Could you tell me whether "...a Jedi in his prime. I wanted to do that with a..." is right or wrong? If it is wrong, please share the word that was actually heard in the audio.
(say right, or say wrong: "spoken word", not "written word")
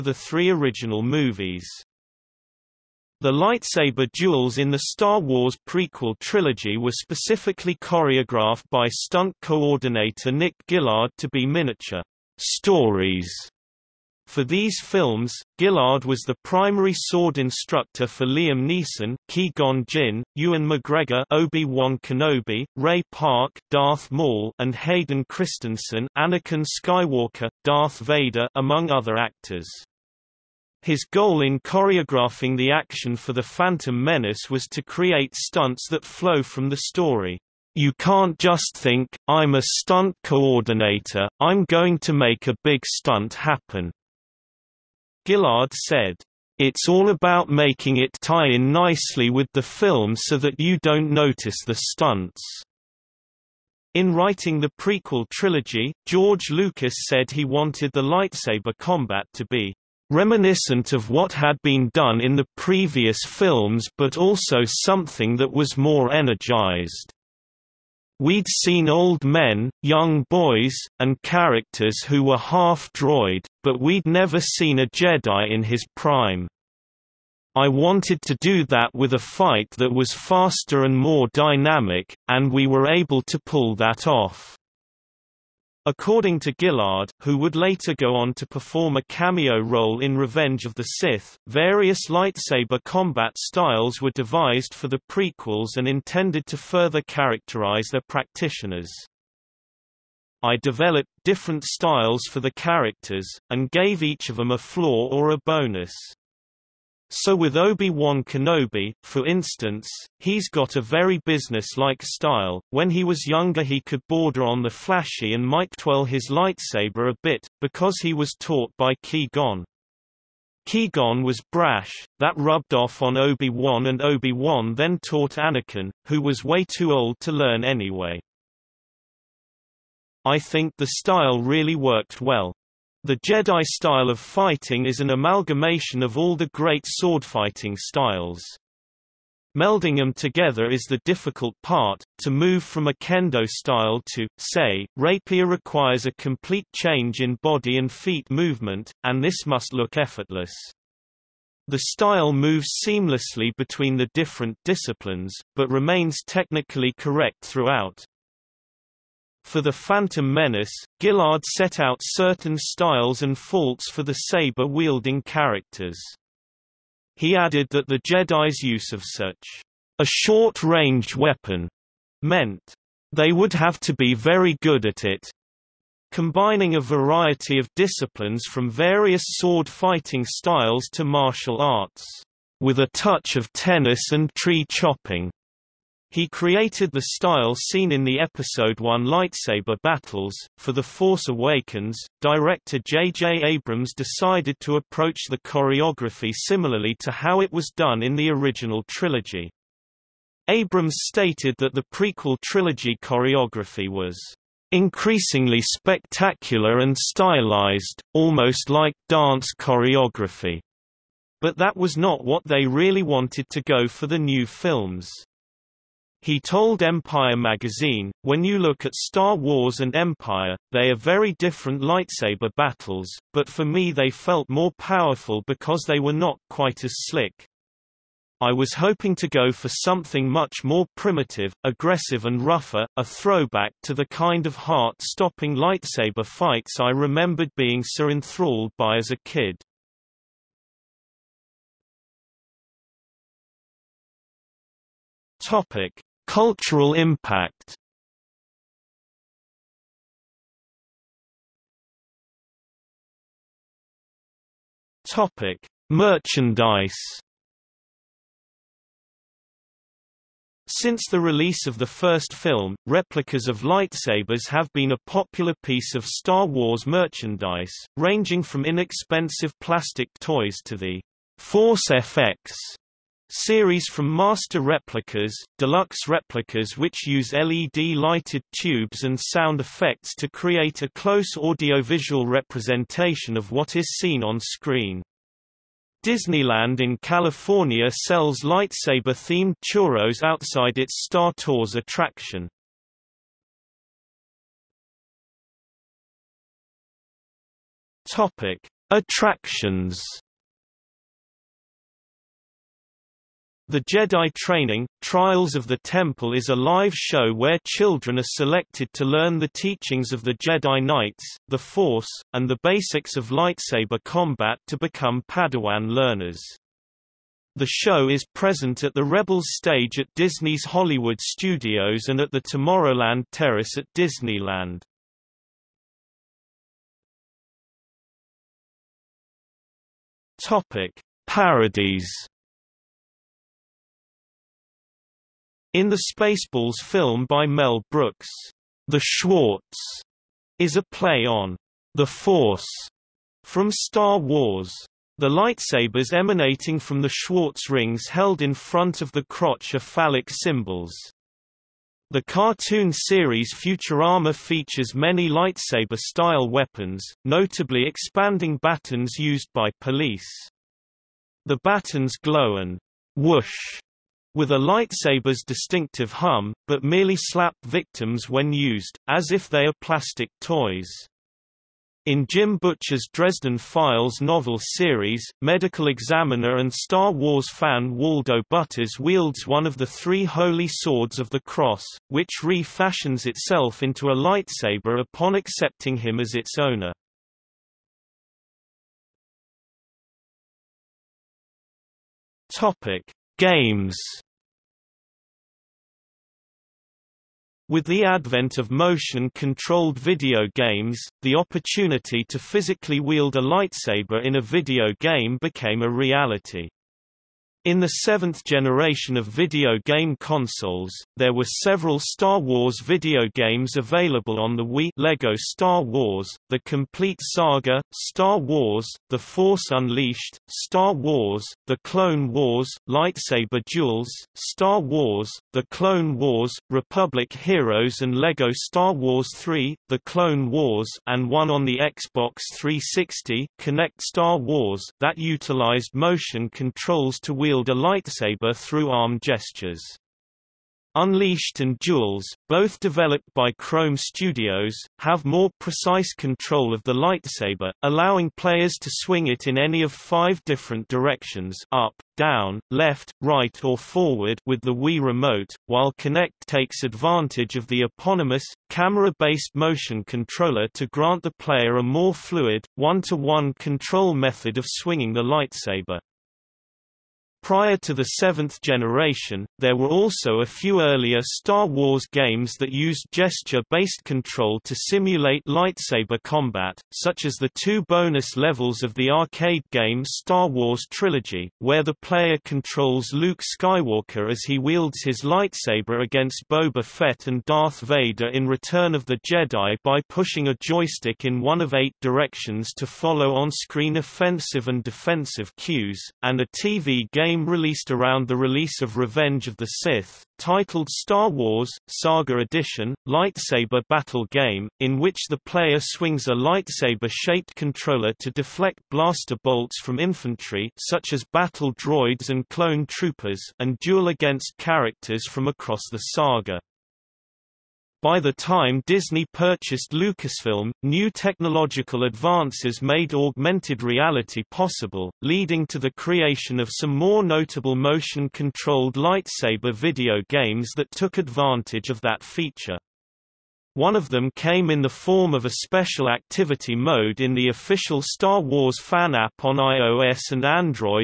right.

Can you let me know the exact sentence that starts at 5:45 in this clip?
The lightsabers emanating from the Schwartz rings held in front of the crotch are phallic symbols.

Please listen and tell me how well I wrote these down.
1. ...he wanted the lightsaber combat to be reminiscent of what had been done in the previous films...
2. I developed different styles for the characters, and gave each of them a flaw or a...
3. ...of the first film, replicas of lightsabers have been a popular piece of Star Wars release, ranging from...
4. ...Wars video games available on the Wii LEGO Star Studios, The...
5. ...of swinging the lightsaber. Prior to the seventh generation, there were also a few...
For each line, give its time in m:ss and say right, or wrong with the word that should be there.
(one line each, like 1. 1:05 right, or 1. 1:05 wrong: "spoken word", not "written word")
1. 0:57 right
2. 1:40 right
3. 4:21 wrong: "merchandise", not "release"
4. 6:52 wrong: "Wars", not "Studios"
5. 7:44 right.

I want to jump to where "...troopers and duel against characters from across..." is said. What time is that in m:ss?
8:32.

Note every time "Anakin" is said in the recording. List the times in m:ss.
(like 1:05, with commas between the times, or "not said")
0:26, 2:05.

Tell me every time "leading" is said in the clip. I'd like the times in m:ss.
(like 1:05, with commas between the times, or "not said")
8:45.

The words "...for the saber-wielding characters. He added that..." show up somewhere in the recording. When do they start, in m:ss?
2:43.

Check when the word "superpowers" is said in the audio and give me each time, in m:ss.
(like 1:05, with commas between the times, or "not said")
not said.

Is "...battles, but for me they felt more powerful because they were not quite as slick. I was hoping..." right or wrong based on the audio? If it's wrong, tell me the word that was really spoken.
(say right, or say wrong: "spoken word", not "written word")
right.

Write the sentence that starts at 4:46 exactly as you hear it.
Disneyland in California sells lightsaber-themed churros outside its Star Tours attraction.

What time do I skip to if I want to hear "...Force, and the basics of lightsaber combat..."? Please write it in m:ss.
5:11.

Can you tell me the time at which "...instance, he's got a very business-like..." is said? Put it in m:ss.
1:49.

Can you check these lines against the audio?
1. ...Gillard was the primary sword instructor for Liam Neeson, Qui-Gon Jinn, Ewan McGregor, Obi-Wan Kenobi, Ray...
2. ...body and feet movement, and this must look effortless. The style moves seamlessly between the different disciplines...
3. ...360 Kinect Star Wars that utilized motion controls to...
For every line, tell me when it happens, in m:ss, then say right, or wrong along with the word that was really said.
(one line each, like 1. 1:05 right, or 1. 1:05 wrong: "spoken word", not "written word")
1. 0:15 right
2. 2:27 right
3. 7:12 right.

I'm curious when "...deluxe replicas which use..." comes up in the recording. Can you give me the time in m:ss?
4:35.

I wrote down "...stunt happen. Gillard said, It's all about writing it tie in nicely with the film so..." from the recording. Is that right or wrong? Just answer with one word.
wrong.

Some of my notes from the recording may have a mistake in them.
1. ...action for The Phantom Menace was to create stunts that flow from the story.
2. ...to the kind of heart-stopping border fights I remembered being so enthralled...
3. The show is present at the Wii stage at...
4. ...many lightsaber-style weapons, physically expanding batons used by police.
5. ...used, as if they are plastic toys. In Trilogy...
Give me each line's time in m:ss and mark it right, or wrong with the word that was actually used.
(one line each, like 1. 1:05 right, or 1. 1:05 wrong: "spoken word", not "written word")
1. 0:32 right
2. 3:53 wrong: "lightsaber", not "border"
3. 5:17 wrong: "Rebels", not "Wii"
4. 5:54 wrong: "notably", not "physically"
5. 6:08 wrong: "Jim", not "Trilogy".